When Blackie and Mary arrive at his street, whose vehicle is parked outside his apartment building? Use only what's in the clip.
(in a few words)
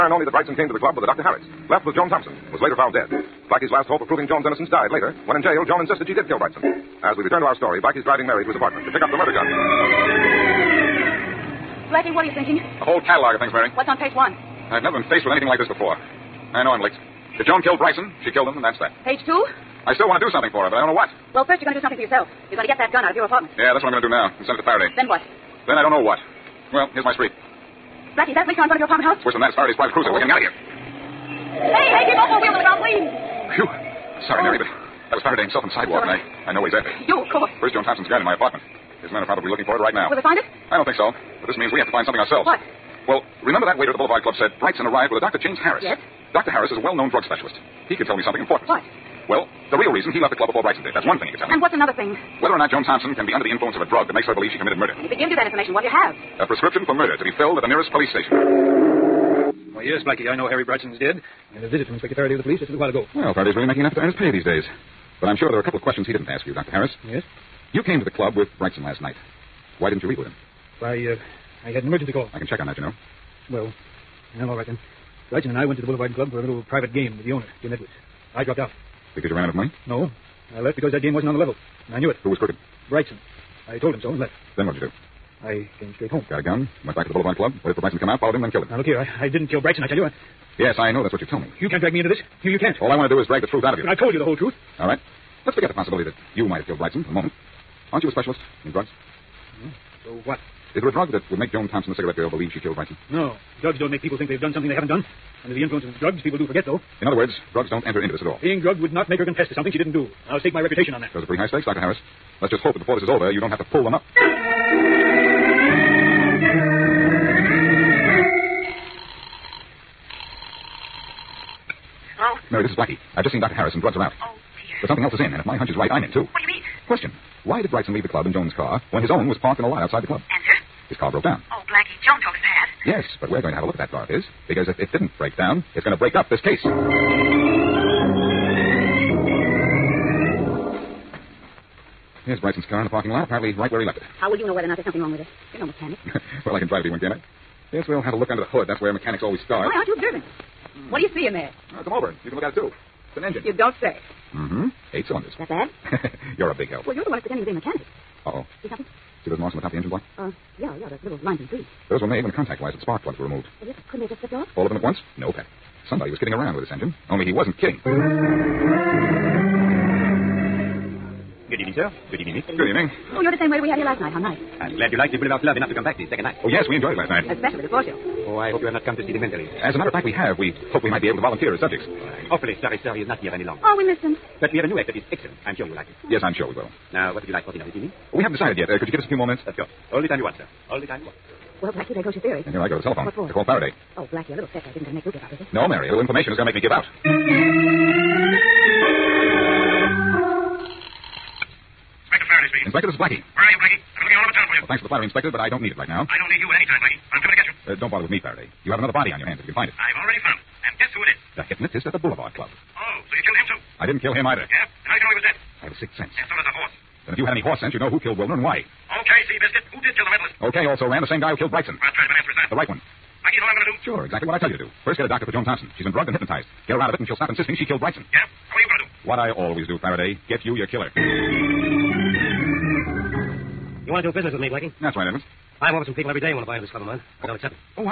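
Farraday's private cruiser.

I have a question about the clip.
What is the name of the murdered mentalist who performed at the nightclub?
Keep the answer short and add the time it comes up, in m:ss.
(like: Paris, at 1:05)
Wilner, at 3:38.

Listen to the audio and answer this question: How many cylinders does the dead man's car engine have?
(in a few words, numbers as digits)
8.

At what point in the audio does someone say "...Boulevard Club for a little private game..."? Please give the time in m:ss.
1:15.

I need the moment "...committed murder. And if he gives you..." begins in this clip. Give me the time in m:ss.
0:54.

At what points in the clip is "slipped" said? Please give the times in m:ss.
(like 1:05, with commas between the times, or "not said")
2:44.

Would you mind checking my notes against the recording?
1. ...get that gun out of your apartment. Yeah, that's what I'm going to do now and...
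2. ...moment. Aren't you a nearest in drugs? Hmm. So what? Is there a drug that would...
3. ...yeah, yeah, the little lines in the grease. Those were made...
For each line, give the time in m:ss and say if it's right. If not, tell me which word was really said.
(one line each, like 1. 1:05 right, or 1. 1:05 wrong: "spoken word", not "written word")
1. 0:22 right
2. 1:37 wrong: "specialist", not "nearest"
3. 2:40 right.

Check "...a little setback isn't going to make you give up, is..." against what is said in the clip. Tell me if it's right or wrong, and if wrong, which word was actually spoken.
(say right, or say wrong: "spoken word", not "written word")
right.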